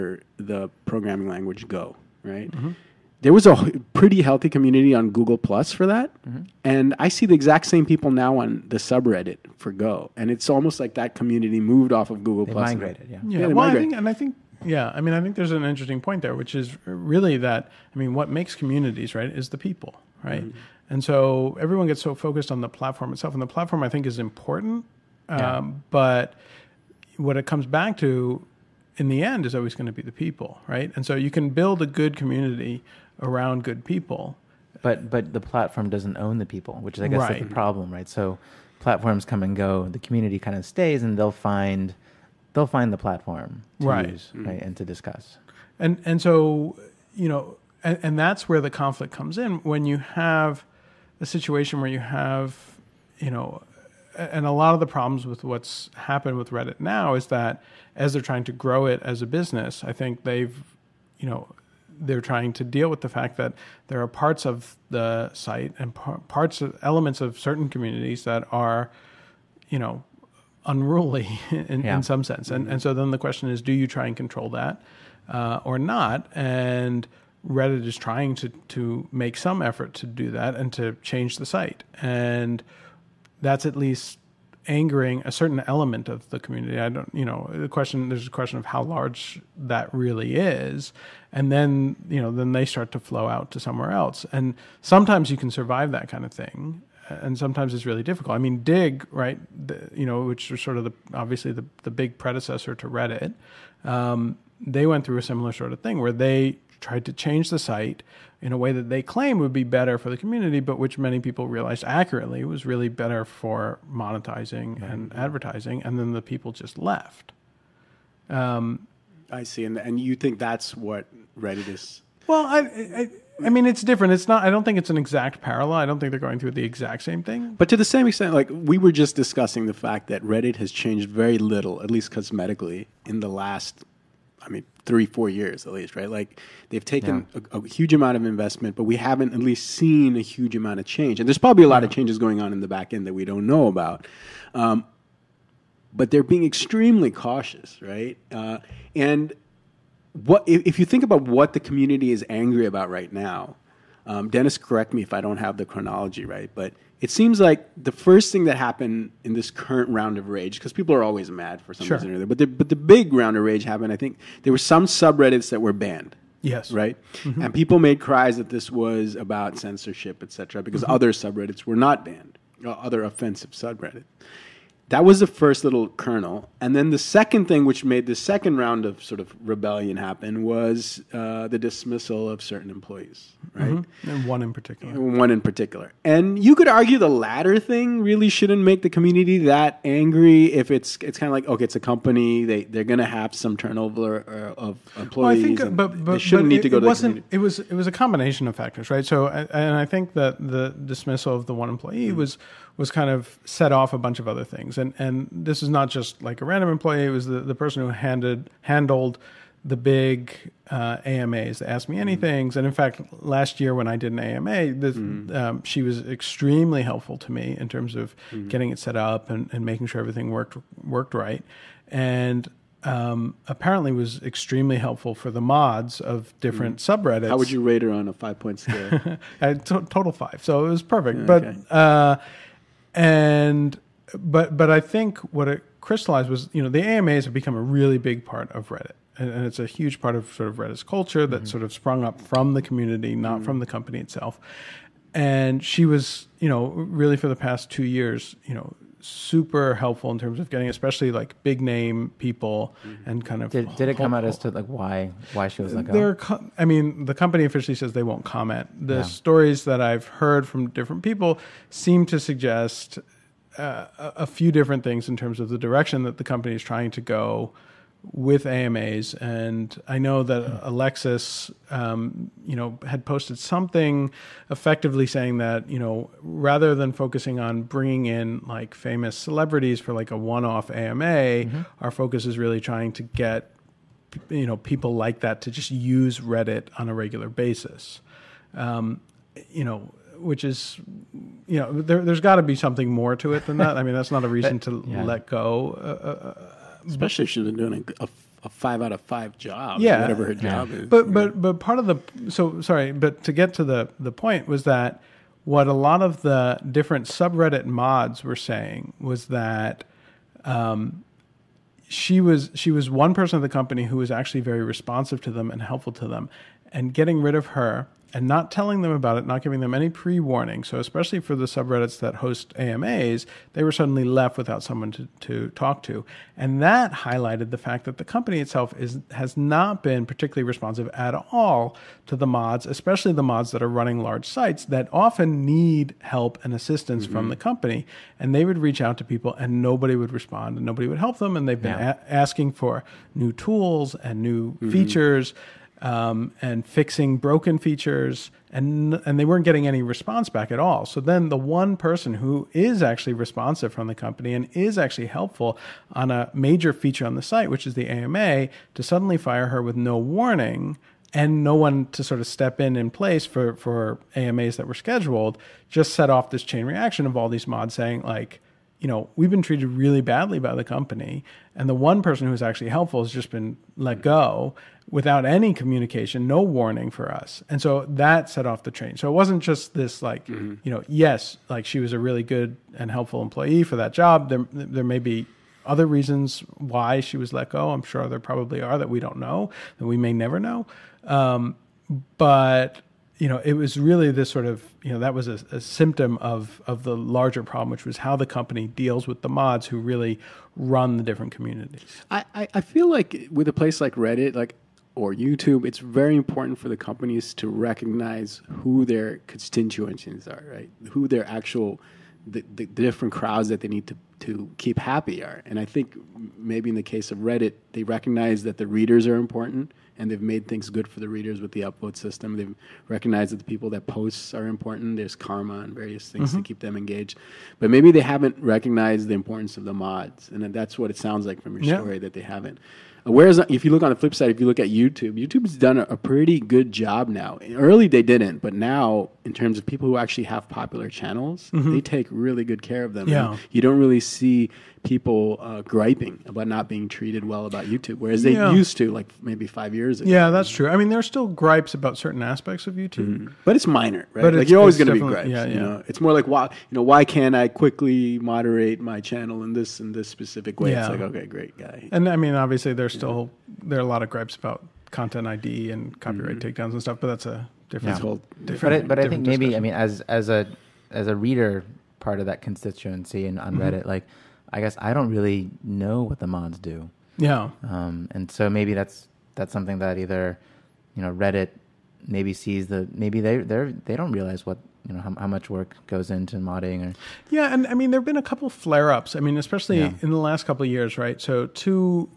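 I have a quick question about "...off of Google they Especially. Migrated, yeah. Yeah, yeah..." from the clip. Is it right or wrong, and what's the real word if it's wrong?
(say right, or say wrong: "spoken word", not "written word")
wrong: "Plus", not "Especially".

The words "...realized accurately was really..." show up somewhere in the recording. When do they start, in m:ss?
1:51.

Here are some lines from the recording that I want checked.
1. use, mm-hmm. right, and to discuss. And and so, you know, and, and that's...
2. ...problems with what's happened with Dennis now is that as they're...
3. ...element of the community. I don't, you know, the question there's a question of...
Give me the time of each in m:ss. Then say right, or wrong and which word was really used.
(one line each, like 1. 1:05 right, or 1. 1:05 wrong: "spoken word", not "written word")
1. 0:44 right
2. 0:54 wrong: "Reddit", not "Dennis"
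3. 1:25 right.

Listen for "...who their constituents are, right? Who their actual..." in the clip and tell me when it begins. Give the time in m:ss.
6:48.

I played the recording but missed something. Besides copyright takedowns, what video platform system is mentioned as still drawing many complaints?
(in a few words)
Content ID.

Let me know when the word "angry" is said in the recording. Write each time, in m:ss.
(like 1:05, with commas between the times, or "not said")
2:32, 3:09.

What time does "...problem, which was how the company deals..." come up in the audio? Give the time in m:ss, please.
6:37.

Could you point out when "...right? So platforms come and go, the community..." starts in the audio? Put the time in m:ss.
0:37.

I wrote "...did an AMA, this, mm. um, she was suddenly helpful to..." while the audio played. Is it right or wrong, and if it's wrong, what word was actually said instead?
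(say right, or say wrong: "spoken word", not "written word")
wrong: "extremely", not "suddenly".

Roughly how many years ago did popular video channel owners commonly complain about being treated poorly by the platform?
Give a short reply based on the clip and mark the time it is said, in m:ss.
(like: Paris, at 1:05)
5 years, at 7:29.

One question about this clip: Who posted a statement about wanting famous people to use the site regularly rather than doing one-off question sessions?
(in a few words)
Alexis.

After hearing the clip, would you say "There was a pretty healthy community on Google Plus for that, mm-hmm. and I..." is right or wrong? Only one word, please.
right.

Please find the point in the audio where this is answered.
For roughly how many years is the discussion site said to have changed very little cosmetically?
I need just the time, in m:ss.
2:14.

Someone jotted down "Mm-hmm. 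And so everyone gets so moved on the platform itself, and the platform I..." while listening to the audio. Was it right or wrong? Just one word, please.
wrong.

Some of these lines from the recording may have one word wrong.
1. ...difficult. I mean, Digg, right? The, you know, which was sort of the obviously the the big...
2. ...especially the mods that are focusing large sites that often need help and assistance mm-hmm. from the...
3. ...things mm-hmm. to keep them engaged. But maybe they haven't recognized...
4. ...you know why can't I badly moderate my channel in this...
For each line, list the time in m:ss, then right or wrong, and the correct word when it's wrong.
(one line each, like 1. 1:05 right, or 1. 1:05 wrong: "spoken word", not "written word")
1. 1:38 right
2. 5:32 wrong: "running", not "focusing"
3. 7:06 right
4. 7:36 wrong: "quickly", not "badly".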